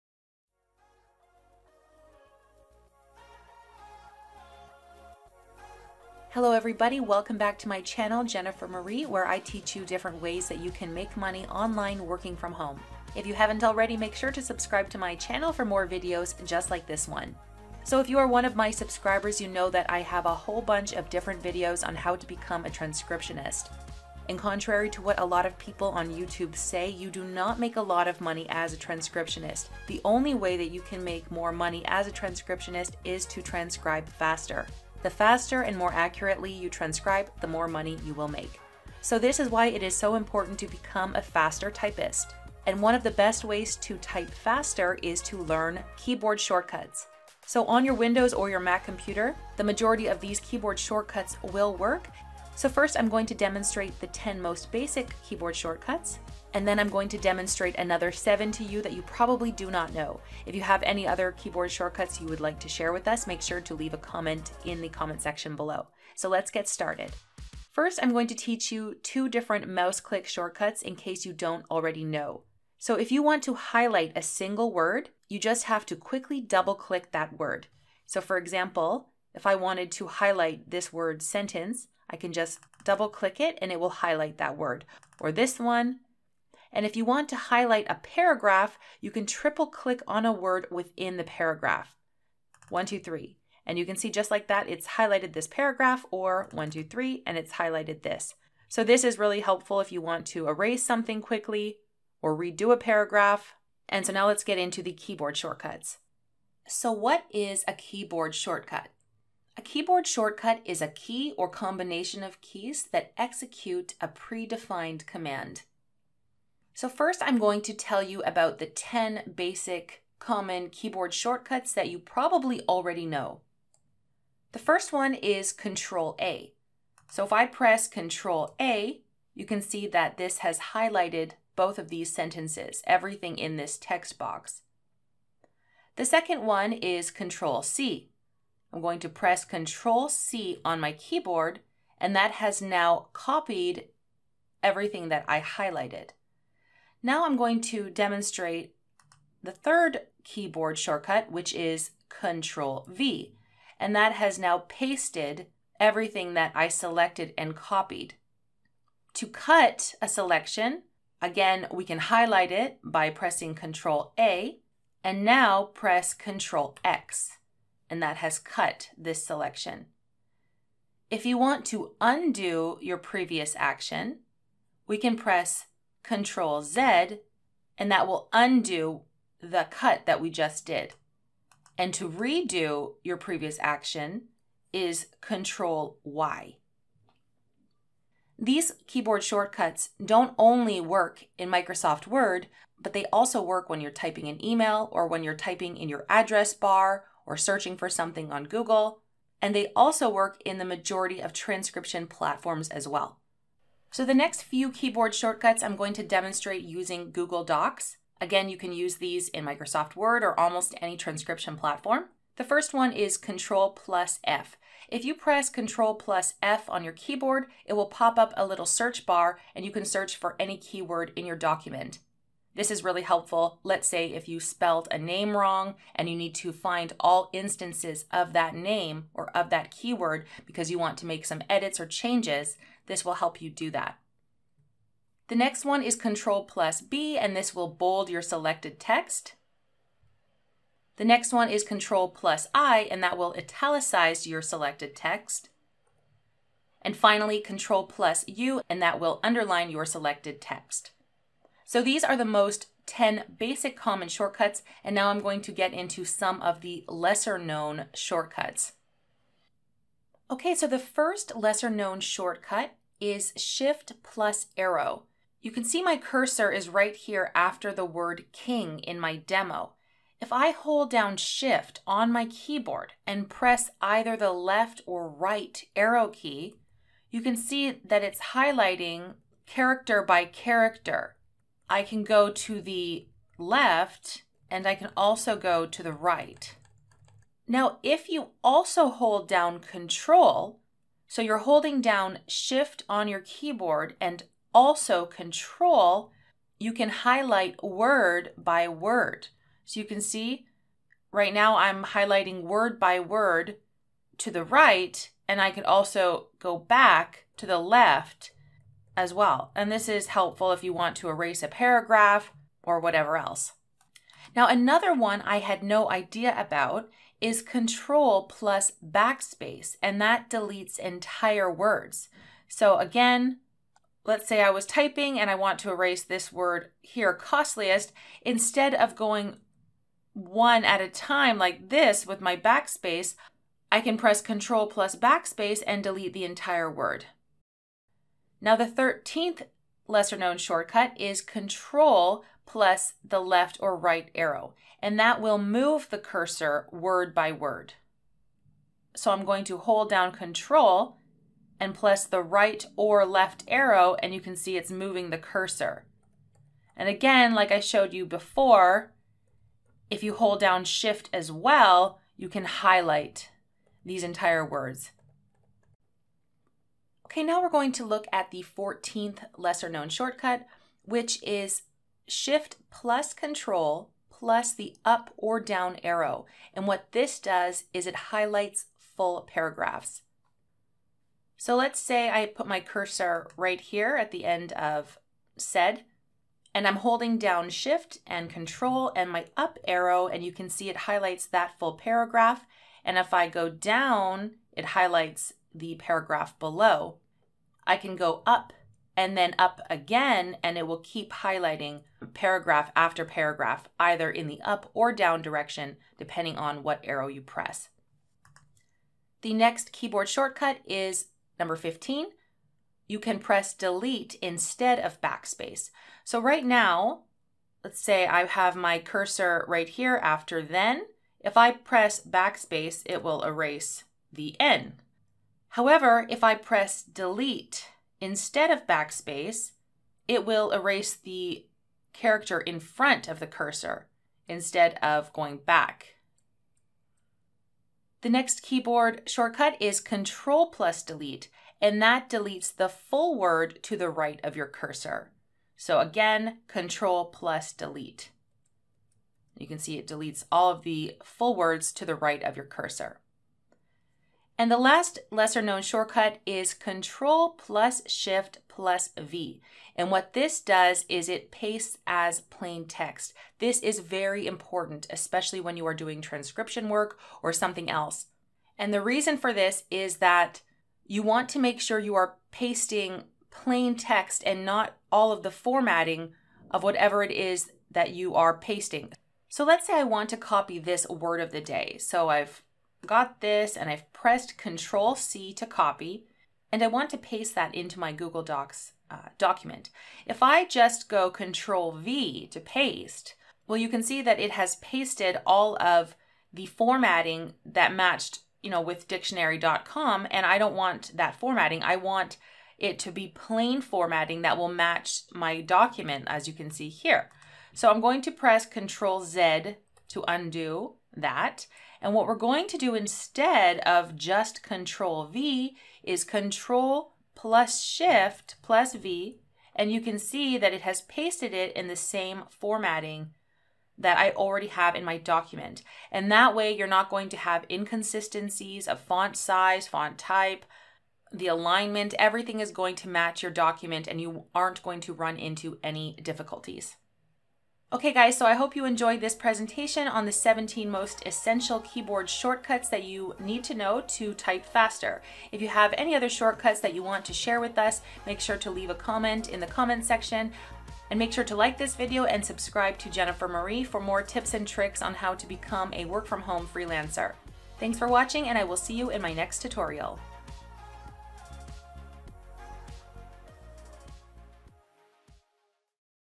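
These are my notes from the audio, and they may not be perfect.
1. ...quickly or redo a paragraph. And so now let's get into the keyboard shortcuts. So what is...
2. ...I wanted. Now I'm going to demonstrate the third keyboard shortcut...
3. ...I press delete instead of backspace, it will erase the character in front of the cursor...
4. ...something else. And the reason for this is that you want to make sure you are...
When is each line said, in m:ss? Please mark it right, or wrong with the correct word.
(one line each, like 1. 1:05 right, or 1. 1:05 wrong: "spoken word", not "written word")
1. 1:41 right
2. 2:25 wrong: "highlighted", not "wanted"
3. 7:06 right
4. 7:47 right.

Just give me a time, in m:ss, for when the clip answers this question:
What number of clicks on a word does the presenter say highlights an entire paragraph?
1:29.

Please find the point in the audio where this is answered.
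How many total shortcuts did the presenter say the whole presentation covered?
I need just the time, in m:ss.
9:00.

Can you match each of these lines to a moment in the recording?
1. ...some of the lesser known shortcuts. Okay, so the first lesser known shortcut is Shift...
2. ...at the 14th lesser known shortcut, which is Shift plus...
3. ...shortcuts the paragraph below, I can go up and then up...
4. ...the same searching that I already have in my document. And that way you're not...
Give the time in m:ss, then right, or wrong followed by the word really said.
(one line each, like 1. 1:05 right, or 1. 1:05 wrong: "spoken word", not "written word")
1. 4:16 right
2. 6:08 right
3. 6:34 wrong: "highlights", not "shortcuts"
4. 8:41 wrong: "formatting", not "searching".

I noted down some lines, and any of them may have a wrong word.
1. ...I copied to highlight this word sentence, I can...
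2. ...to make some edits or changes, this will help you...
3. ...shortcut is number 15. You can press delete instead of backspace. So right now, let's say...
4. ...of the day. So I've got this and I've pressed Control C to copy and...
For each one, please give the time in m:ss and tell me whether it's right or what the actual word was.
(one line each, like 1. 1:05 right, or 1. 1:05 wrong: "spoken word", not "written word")
1. 1:19 wrong: "wanted", not "copied"
2. 3:50 right
3. 6:50 right
4. 8:01 right.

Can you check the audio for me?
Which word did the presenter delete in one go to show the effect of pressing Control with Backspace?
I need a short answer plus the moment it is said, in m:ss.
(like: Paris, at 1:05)
costliest, at 5:27.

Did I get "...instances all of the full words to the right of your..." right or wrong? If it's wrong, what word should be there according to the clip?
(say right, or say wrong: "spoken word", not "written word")
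wrong: "deletes", not "instances".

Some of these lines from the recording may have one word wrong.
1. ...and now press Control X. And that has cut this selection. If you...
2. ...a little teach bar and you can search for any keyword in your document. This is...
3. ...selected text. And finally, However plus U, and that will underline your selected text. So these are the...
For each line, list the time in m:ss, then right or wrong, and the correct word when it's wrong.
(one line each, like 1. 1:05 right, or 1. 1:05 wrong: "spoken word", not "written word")
1. 2:45 right
2. 3:38 wrong: "search", not "teach"
3. 4:04 wrong: "Control", not "However".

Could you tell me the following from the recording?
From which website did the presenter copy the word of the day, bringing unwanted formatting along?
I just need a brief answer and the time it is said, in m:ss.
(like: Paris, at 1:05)
dictionary.com, at 8:18.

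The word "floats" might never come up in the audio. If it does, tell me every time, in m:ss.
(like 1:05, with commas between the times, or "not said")
not said.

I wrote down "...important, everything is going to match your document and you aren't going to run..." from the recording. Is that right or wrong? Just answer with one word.
wrong.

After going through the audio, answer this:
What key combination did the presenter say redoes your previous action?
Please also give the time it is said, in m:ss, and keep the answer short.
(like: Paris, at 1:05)
Control Y, at 3:05.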